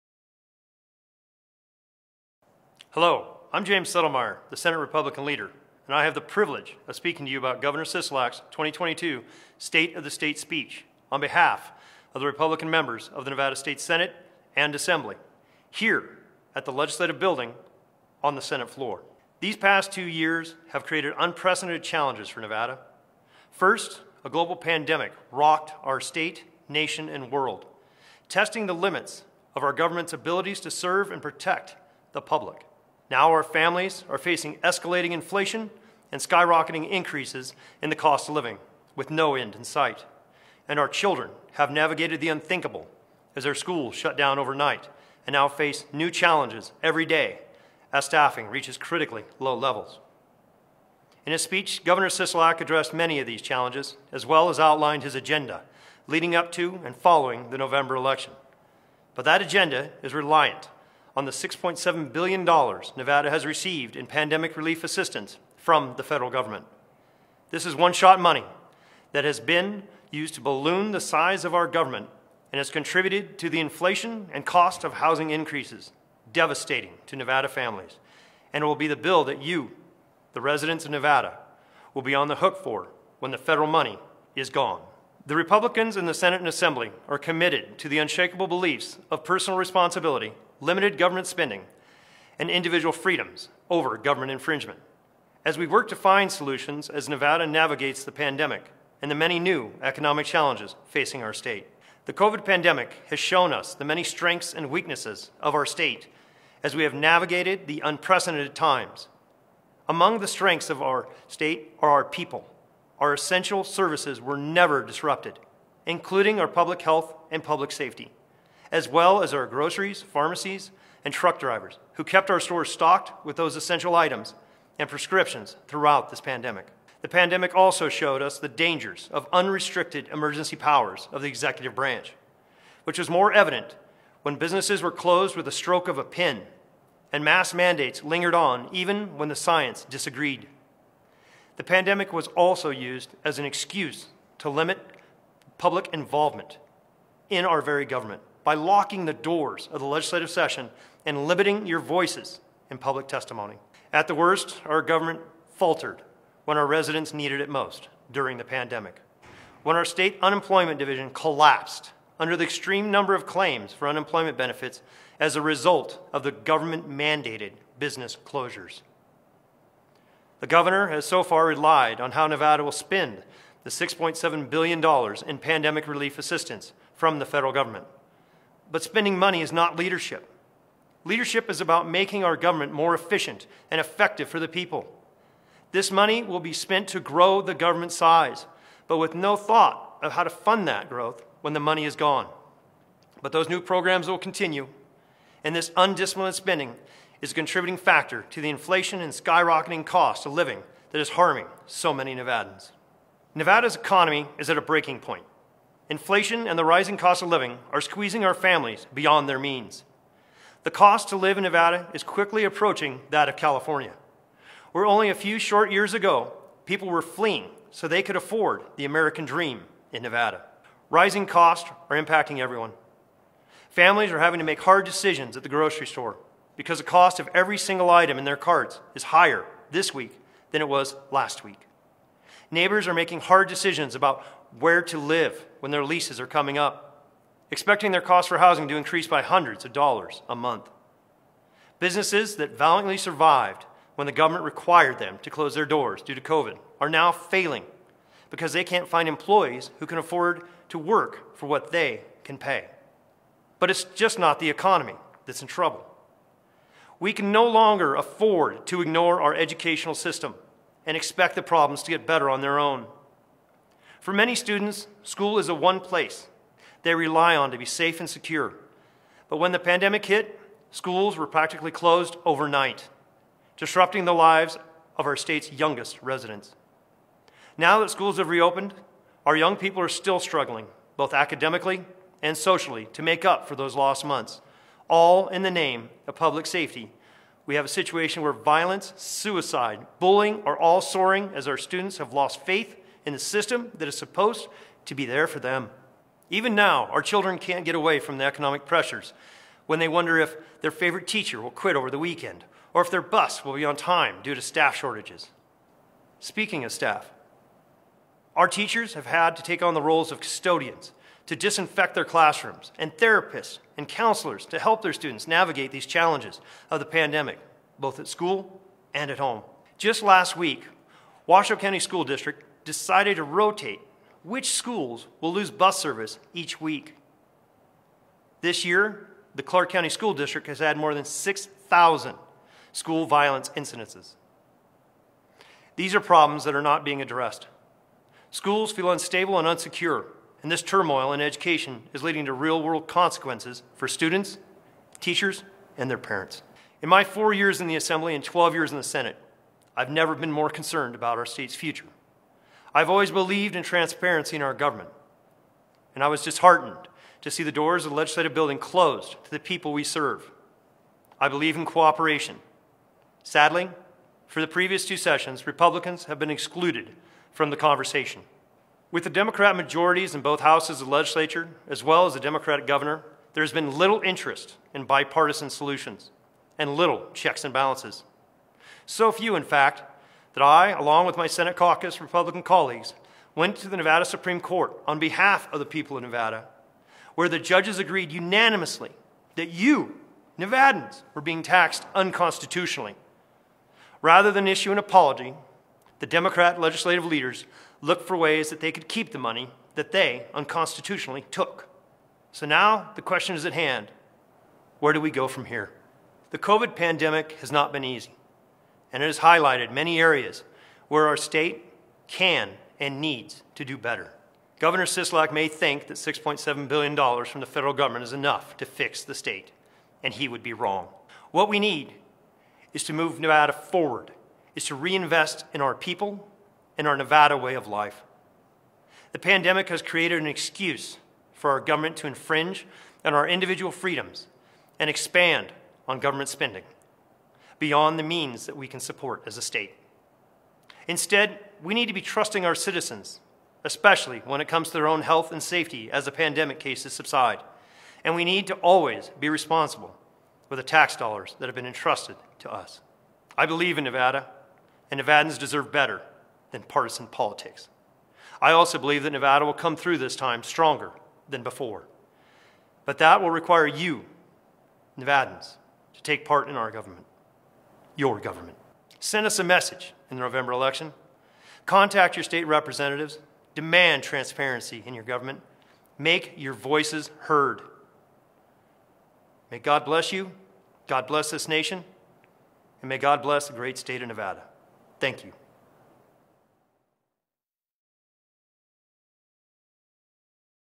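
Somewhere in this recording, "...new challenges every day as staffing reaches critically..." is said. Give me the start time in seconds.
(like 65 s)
45 s.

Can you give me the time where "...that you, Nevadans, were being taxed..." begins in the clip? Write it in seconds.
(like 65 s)
389 s.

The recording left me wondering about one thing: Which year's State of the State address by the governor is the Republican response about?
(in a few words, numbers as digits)
2022.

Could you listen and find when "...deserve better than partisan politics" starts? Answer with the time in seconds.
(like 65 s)
455 s.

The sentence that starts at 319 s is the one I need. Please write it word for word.
Just last week, Washoe County School District decided to rotate which schools will lose bus service each week.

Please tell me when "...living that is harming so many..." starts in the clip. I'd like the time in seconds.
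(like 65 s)
200 s.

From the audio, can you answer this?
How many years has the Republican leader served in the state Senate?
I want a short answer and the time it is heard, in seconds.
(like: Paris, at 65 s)
12, at 348 s.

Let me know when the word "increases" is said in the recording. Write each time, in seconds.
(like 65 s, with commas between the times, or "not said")
36 s, 75 s, 238 s.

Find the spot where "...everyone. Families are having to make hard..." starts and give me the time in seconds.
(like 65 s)
222 s.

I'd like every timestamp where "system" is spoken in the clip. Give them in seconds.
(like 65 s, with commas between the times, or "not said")
259 s, 293 s.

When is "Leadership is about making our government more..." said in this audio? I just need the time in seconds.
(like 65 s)
181 s.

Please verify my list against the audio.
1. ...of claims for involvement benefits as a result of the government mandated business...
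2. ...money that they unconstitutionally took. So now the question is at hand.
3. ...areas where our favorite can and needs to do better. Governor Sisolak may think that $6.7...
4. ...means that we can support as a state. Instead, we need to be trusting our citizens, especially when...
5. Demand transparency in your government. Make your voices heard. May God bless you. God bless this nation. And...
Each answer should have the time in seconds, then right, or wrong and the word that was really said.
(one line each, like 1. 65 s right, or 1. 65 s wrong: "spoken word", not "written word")
1. 163 s wrong: "unemployment", not "involvement"
2. 399 s right
3. 409 s wrong: "state", not "favorite"
4. 438 s right
5. 473 s right.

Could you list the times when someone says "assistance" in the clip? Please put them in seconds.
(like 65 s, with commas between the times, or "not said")
64 s, 176 s.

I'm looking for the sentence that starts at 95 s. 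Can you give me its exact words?
As we work to find solutions as Nevada navigates the pandemic and the many new economic challenges facing our state.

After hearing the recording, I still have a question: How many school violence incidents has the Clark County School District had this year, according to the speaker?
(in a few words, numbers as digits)
More than 6,000.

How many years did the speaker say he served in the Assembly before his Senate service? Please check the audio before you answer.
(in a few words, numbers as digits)
4.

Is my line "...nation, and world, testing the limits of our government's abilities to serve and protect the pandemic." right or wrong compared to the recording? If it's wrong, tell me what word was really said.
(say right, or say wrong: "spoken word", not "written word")
wrong: "public", not "pandemic".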